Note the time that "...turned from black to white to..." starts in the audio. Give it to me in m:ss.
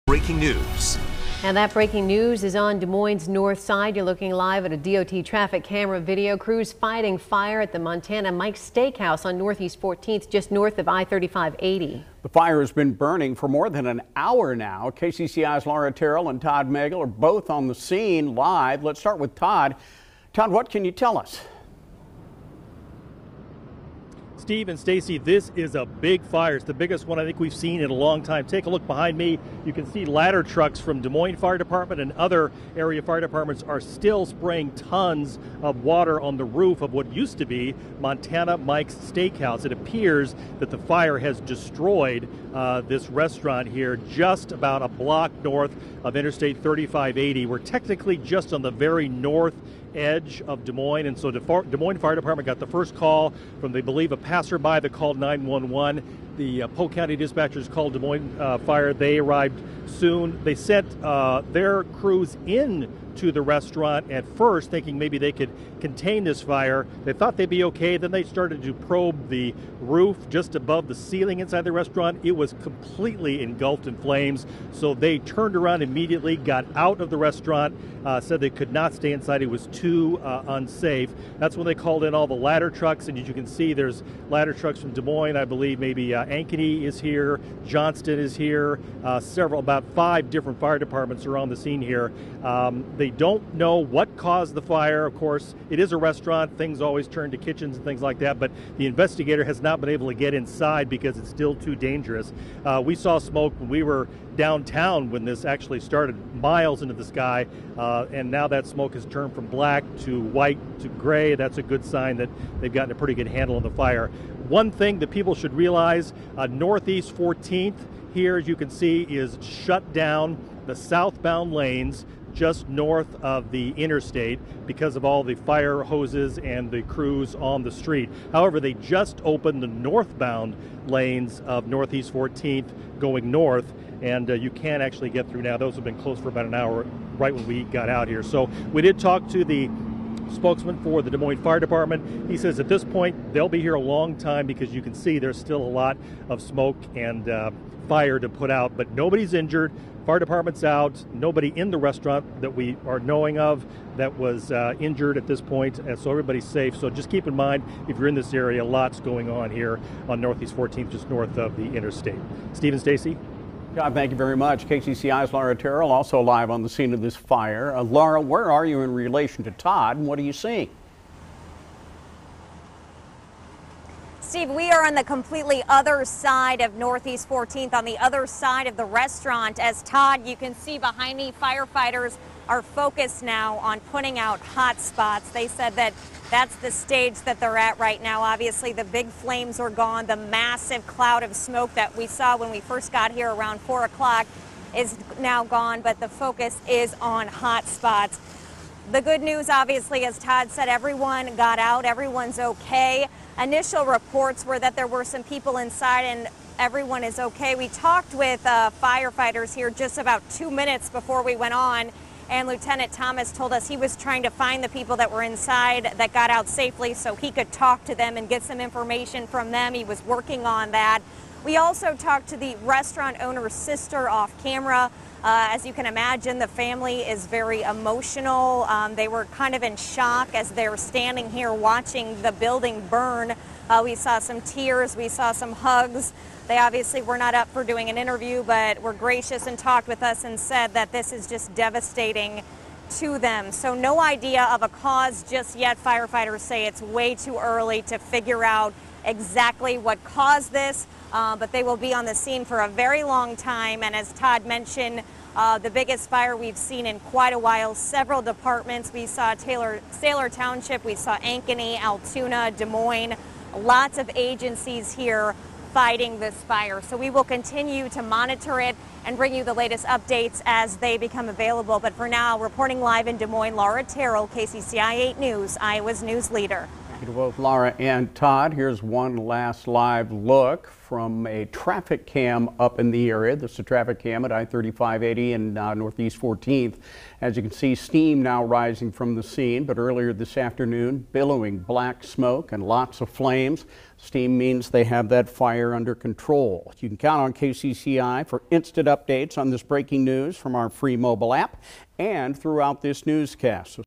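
1:49.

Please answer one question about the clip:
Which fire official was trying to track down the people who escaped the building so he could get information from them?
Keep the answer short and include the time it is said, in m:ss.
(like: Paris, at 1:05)
Lieutenant Thomas, at 3:32.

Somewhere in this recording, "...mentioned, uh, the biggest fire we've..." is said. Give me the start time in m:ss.
4:14.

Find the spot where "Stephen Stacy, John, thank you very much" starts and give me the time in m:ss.
2:42.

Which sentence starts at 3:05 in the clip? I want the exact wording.
They said that that's the stage that they're at right now.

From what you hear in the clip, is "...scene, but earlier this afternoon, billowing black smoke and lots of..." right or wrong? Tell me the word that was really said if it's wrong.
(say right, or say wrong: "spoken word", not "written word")
right.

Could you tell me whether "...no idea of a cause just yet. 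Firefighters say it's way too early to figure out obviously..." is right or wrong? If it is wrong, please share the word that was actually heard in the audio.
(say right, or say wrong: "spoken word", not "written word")
wrong: "exactly", not "obviously".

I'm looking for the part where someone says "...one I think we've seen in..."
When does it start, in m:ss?
0:27.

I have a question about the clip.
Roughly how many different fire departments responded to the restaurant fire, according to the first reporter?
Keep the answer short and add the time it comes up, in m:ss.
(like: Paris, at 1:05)
5, at 1:29.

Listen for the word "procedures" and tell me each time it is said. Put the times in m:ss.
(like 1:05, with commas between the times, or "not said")
not said.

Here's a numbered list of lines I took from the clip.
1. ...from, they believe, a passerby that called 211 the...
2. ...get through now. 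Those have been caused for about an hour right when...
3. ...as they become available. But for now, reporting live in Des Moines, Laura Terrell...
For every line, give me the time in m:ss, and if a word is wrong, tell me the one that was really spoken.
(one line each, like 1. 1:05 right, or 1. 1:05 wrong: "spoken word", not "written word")
1. 0:53 wrong: "911", not "211"
2. 2:15 wrong: "closed", not "caused"
3. 4:30 right.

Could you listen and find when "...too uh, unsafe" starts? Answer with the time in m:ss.
1:19.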